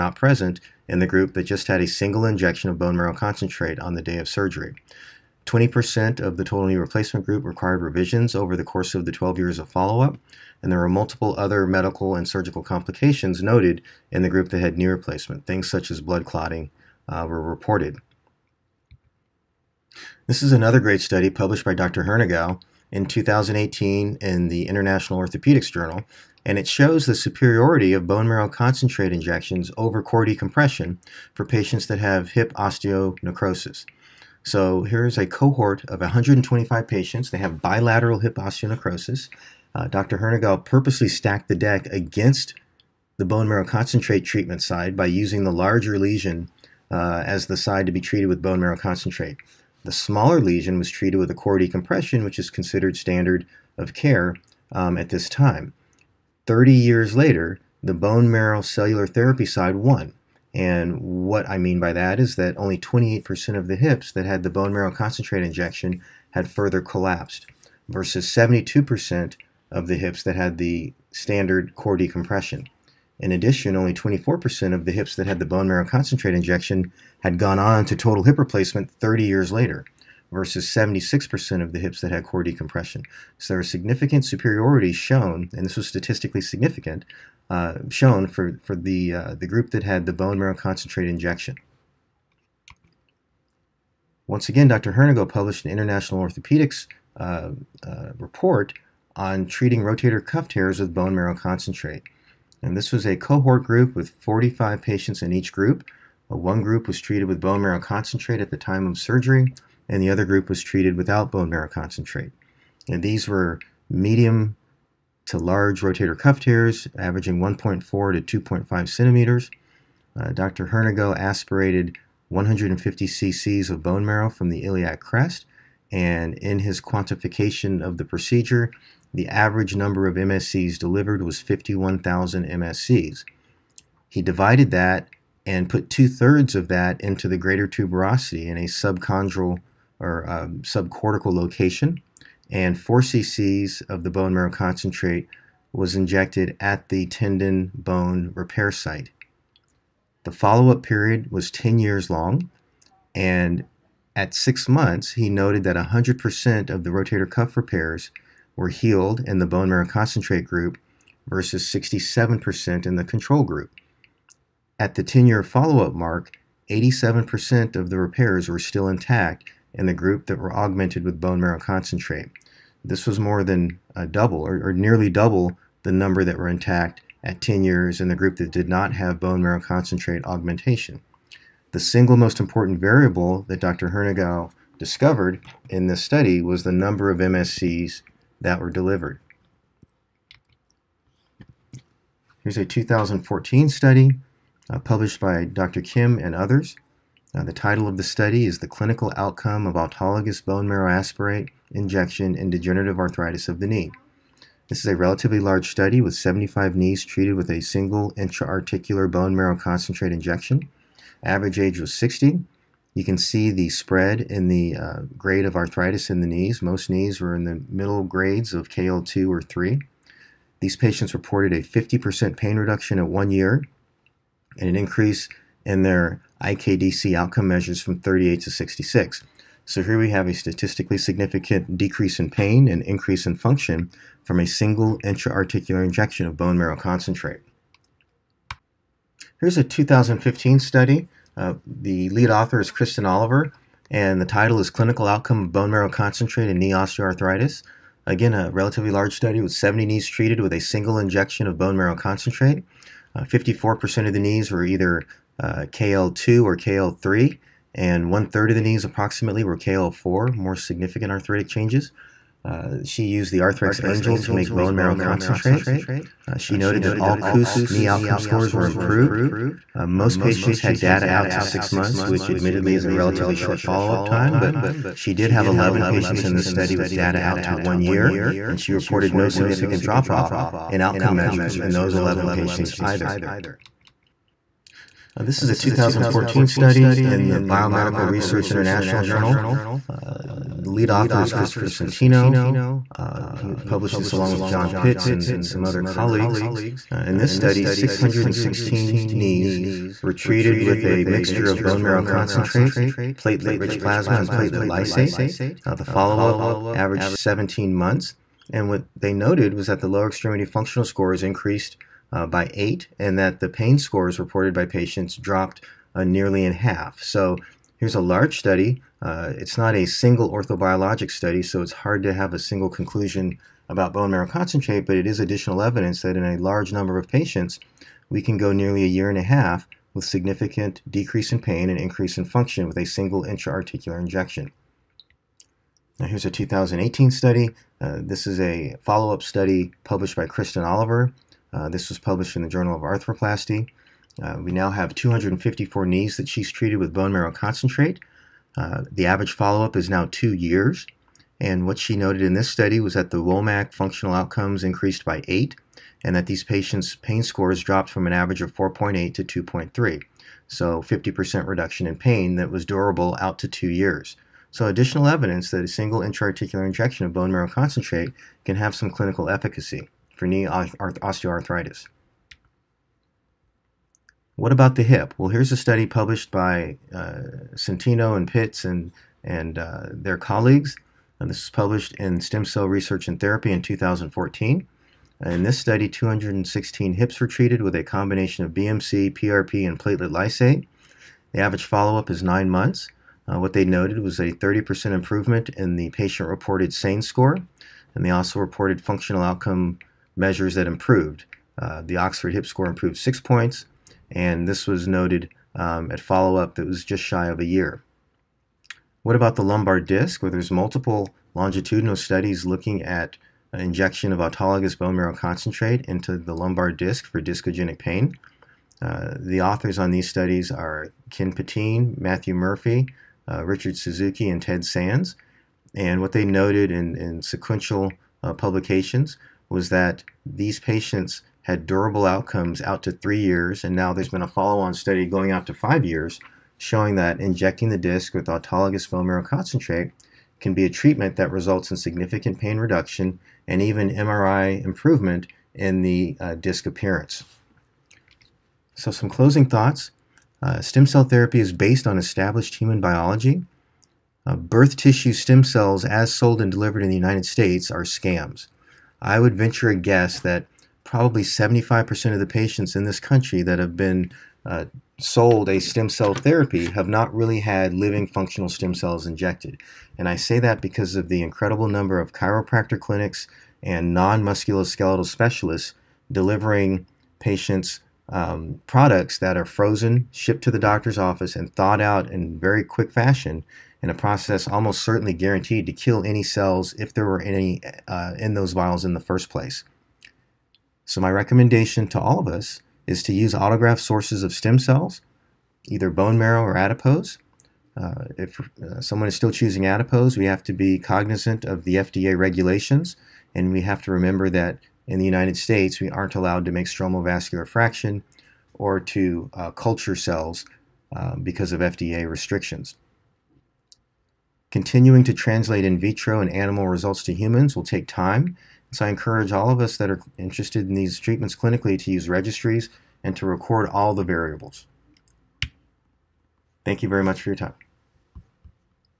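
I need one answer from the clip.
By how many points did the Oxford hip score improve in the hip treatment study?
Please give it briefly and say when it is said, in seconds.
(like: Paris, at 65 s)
6, at 402 s.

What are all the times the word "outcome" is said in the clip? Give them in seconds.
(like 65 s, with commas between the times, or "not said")
199 s, 227 s, 245 s, 267 s, 280 s, 354 s, 399 s, 432 s.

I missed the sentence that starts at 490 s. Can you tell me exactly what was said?
So my recommendation to all of us is to use autograft sources of stem cells, either bone marrow or adipose.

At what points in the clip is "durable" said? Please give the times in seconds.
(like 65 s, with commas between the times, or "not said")
362 s, 431 s.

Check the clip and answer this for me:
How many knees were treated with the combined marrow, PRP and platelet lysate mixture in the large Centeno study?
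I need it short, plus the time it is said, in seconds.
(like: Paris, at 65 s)
616, at 297 s.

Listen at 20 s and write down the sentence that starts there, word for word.
This is another great study published by Dr.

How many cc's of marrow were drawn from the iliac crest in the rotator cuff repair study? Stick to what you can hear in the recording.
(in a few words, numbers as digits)
150 cc's.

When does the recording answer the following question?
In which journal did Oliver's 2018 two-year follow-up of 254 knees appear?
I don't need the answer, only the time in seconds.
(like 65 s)
342 s.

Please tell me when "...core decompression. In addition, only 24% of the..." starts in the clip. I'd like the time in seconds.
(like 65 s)
71 s.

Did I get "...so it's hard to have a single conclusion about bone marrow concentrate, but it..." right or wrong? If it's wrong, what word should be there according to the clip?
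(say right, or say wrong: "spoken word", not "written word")
right.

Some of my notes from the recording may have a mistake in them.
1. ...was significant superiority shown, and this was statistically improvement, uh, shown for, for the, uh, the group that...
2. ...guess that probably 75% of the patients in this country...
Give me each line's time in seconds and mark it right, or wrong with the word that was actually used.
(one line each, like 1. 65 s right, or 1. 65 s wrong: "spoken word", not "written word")
1. 83 s wrong: "significant", not "improvement"
2. 459 s right.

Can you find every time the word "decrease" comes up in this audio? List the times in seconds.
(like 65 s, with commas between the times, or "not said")
231 s, 330 s.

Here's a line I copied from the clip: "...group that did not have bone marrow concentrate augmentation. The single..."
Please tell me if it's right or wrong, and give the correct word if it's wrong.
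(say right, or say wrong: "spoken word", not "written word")
right.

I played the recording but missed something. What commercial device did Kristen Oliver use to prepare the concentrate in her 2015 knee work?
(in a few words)
Arthrex Angel.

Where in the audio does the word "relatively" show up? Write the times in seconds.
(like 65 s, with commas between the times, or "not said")
204 s, 248 s, 272 s.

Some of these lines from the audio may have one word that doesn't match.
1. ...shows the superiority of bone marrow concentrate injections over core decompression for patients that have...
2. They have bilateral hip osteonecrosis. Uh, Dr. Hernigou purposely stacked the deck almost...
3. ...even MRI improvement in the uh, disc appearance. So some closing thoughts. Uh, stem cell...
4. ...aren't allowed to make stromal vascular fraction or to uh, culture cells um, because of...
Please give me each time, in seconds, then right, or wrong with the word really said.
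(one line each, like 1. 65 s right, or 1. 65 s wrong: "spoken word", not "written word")
1. 26 s right
2. 37 s wrong: "against", not "almost"
3. 443 s right
4. 505 s right.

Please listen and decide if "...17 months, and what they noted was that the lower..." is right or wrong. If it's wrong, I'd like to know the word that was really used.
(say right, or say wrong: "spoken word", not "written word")
right.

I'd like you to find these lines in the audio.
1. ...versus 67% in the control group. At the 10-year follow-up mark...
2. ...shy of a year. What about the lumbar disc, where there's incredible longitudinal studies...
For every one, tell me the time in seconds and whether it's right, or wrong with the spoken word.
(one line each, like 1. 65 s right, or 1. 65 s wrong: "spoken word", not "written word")
1. 161 s right
2. 407 s wrong: "multiple", not "incredible".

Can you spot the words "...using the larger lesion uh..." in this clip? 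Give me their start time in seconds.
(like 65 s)
45 s.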